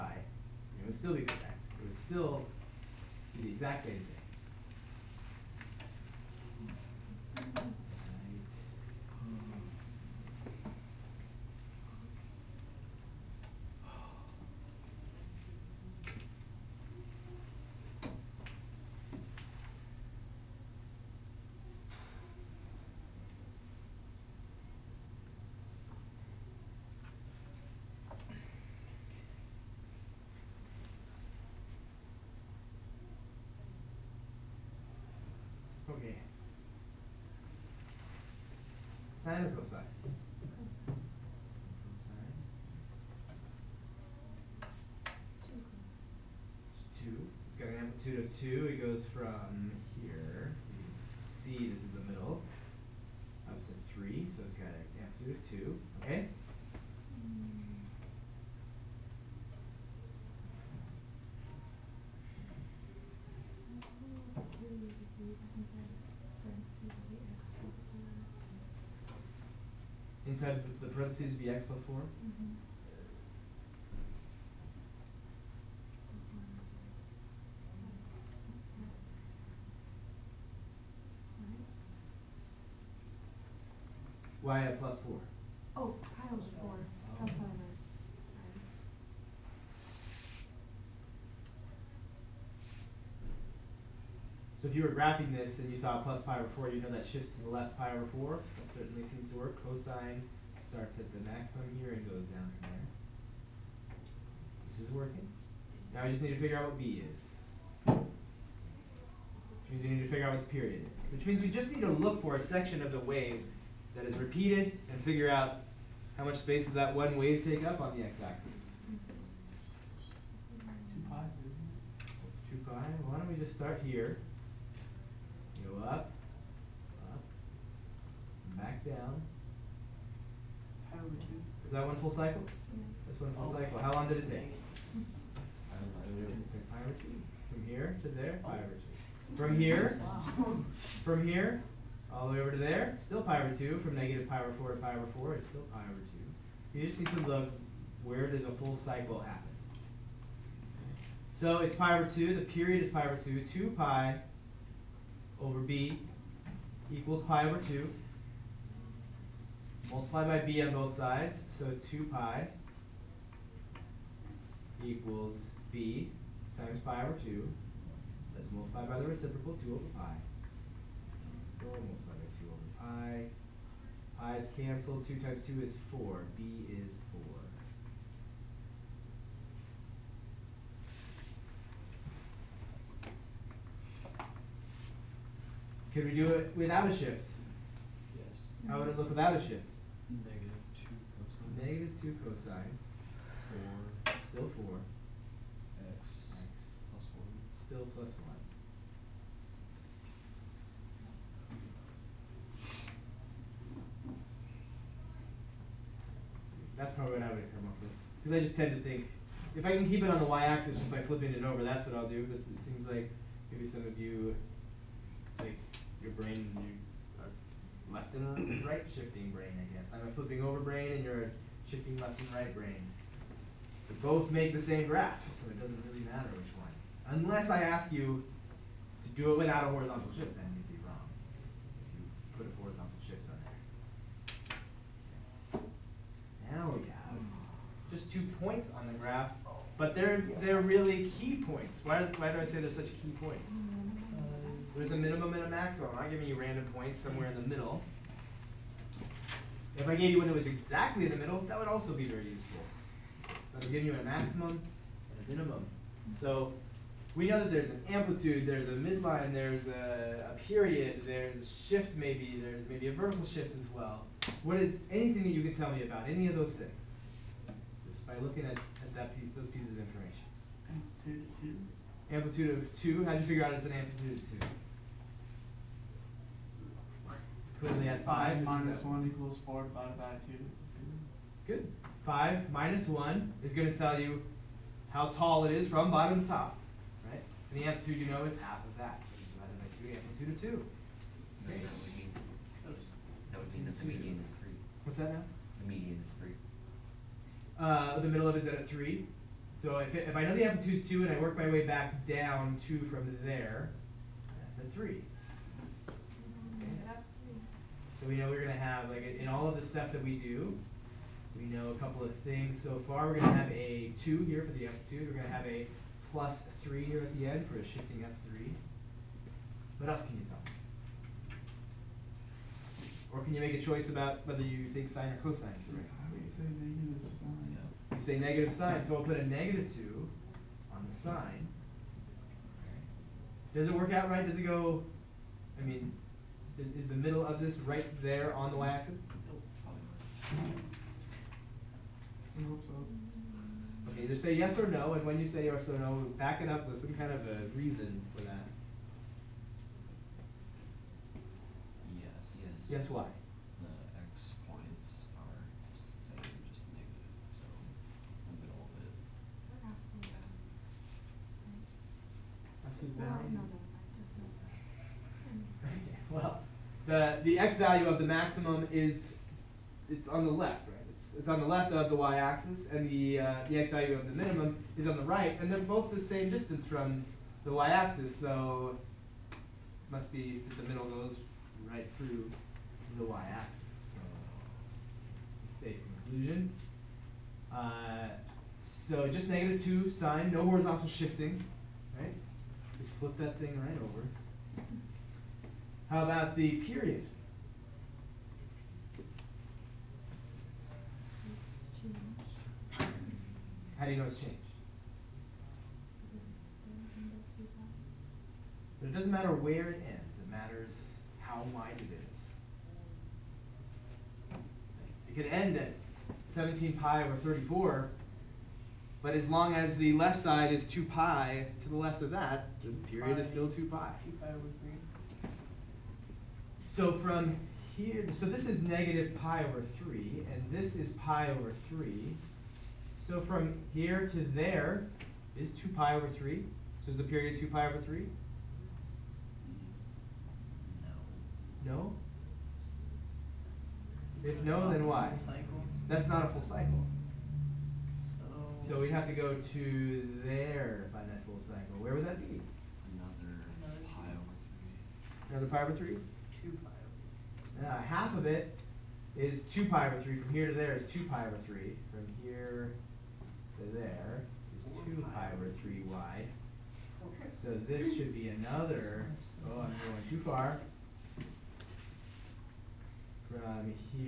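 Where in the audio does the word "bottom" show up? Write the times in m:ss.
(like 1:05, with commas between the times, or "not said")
4:45.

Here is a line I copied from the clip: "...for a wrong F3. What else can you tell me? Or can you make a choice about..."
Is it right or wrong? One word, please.
wrong.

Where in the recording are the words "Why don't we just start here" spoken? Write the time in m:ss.
2:03.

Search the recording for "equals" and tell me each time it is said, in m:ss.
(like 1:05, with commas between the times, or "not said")
2:36, 2:44, 4:39.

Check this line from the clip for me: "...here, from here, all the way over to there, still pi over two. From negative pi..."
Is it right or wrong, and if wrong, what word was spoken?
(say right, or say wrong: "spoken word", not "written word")
right.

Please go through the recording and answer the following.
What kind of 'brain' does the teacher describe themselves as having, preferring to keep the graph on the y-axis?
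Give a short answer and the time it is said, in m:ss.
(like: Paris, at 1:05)
flipping over brain, at 3:39.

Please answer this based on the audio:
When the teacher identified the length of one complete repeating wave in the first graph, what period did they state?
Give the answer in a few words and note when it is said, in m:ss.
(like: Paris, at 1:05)
pi over 2, at 2:32.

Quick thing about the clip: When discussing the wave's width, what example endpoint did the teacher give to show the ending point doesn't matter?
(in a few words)
17 pi over 34.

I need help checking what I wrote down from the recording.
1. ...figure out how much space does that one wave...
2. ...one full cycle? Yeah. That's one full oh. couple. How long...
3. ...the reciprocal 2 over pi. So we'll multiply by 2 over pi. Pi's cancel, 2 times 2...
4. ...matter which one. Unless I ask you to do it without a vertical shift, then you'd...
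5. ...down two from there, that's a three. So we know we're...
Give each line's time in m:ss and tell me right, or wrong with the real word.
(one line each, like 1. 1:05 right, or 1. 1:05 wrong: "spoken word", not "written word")
1. 1:55 right
2. 2:11 wrong: "cycle", not "couple"
3. 2:48 right
4. 3:46 wrong: "horizontal", not "vertical"
5. 5:02 right.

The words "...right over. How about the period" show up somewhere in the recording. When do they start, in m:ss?
6:33.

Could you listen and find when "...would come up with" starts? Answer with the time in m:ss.
3:27.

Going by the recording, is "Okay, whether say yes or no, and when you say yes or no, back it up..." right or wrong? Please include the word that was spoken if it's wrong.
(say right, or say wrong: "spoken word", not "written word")
wrong: "either", not "whether".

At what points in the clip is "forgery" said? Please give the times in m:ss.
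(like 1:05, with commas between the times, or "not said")
not said.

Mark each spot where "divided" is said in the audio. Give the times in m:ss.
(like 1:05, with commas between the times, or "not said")
4:39, 4:49.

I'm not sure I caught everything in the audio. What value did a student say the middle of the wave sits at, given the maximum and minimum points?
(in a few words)
3.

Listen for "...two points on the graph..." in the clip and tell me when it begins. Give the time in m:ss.
3:58.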